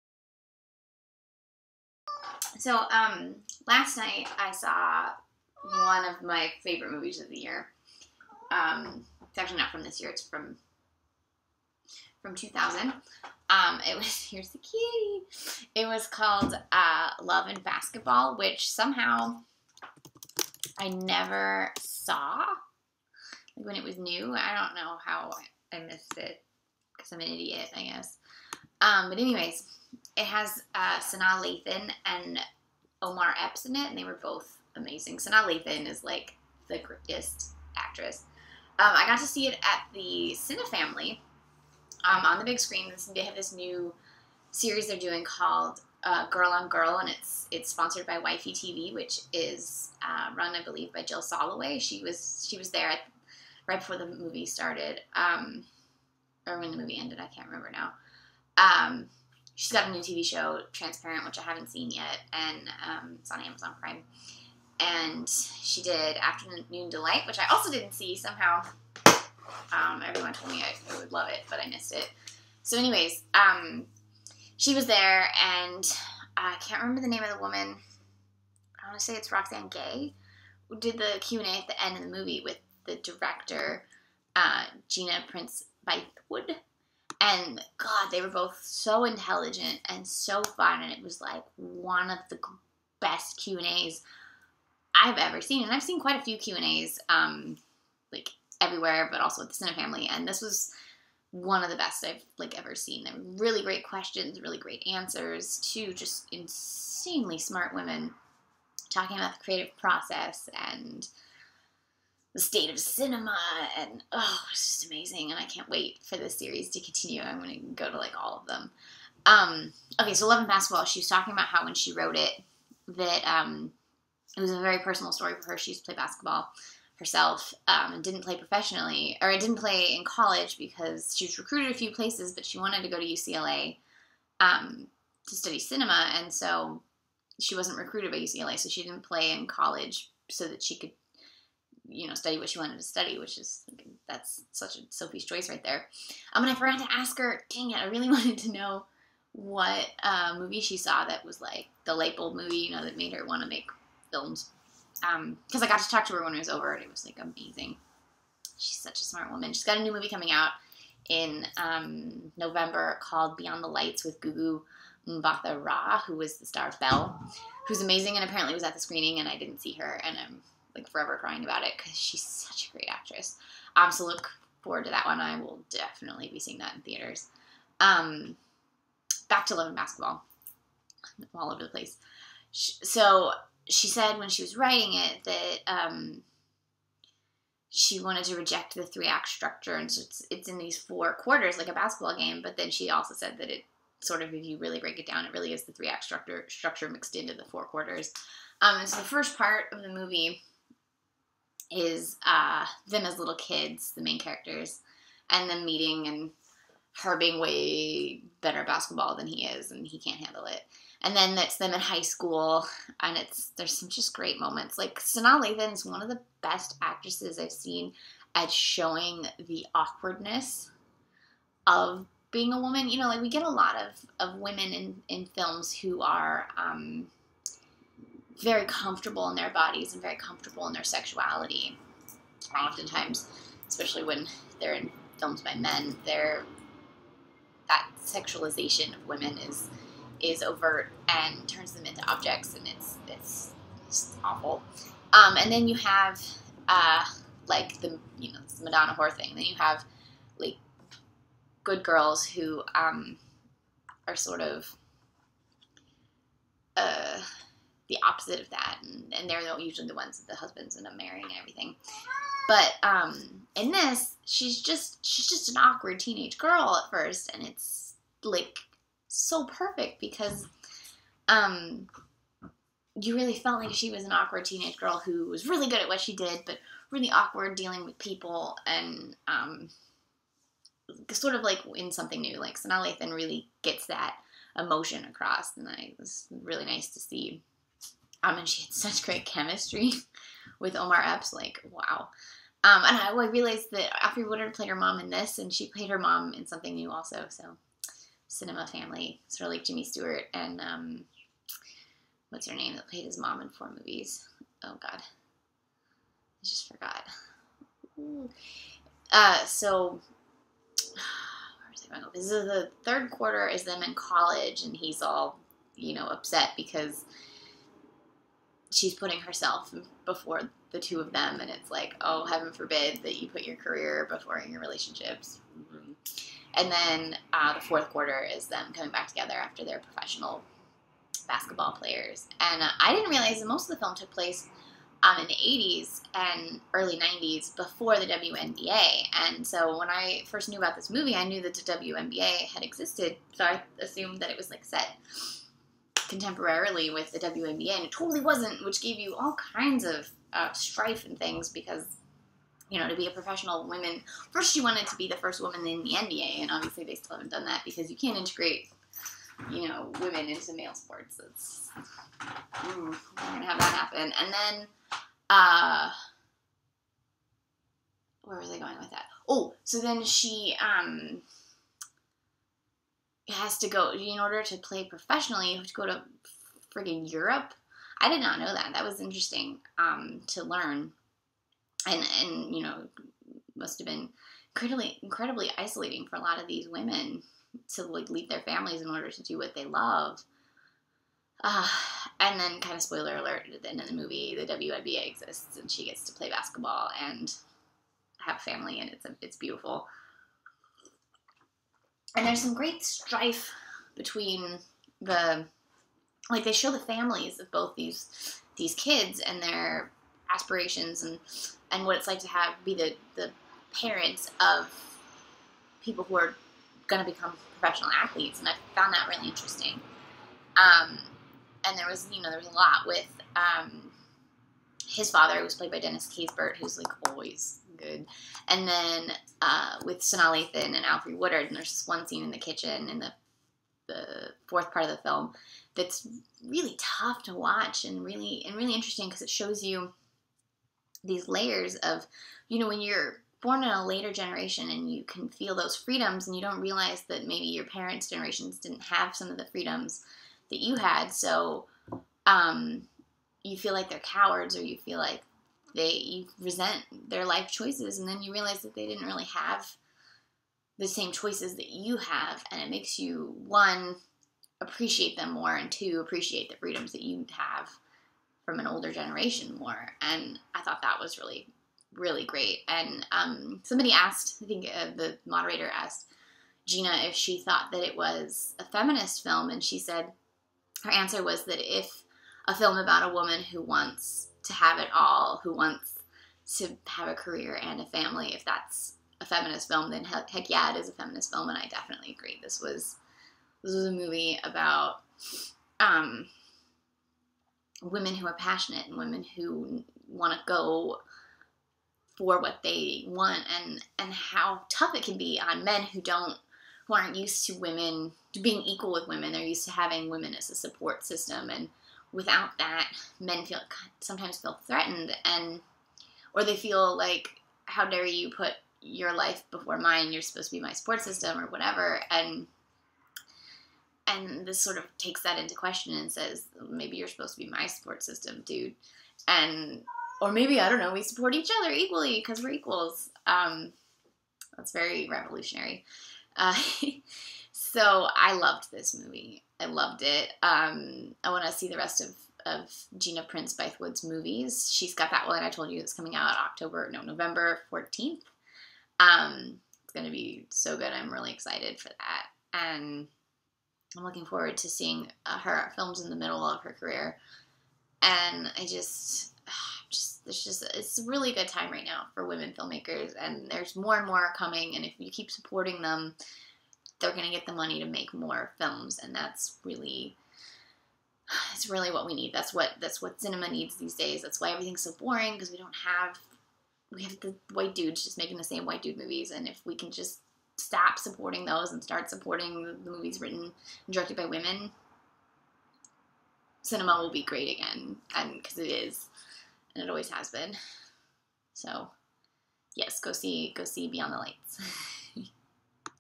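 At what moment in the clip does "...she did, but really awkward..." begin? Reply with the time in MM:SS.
04:35.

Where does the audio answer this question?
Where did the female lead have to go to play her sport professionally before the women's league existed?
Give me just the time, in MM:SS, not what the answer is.
06:17.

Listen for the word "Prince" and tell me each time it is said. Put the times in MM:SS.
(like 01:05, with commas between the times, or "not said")
01:25, 09:03.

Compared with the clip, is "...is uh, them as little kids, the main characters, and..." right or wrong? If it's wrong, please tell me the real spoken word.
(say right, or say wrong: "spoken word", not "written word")
right.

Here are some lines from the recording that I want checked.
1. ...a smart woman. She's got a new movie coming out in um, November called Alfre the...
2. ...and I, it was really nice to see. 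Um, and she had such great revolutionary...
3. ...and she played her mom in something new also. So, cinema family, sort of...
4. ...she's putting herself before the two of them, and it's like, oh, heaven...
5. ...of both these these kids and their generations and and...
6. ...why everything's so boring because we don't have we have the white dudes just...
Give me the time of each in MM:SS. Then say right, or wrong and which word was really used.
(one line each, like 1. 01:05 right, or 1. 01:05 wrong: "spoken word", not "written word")
1. 02:39 wrong: "Beyond", not "Alfre"
2. 04:45 wrong: "chemistry", not "revolutionary"
3. 04:55 right
4. 05:18 right
5. 06:47 wrong: "aspirations", not "generations"
6. 09:34 right.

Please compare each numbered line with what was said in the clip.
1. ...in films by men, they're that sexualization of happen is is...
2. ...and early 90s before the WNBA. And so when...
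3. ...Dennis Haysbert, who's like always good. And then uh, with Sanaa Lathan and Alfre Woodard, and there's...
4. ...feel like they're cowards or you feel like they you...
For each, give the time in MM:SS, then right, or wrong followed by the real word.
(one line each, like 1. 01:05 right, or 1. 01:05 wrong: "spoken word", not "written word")
1. 03:54 wrong: "women", not "happen"
2. 05:36 right
3. 07:05 right
4. 07:33 right.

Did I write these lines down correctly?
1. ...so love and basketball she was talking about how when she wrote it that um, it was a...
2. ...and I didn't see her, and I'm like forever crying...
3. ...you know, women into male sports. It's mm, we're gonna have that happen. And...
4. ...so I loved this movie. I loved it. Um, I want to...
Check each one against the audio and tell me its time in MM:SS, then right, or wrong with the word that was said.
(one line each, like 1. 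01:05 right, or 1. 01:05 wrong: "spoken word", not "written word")
1. 02:00 right
2. 02:49 right
3. 05:59 right
4. 08:57 right.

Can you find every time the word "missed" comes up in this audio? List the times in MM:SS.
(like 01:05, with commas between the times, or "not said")
00:25, 01:11.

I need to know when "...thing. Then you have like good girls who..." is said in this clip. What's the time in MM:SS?
04:09.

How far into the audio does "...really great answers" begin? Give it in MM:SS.
01:44.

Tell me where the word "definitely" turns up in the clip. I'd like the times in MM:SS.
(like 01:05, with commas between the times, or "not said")
02:55, 08:11.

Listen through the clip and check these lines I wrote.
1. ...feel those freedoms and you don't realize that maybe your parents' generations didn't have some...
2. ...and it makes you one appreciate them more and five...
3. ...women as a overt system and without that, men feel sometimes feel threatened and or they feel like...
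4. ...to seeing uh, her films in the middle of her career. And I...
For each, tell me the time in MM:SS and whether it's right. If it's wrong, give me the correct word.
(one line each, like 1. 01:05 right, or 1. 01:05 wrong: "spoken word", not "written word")
1. 07:25 right
2. 07:42 wrong: "two", not "five"
3. 08:30 wrong: "support", not "overt"
4. 09:14 right.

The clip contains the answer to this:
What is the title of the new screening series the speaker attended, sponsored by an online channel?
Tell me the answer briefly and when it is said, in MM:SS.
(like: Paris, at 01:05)
Girl on Girl, at 00:46.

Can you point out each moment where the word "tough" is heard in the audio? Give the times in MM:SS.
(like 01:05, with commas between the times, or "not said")
07:16, 08:24.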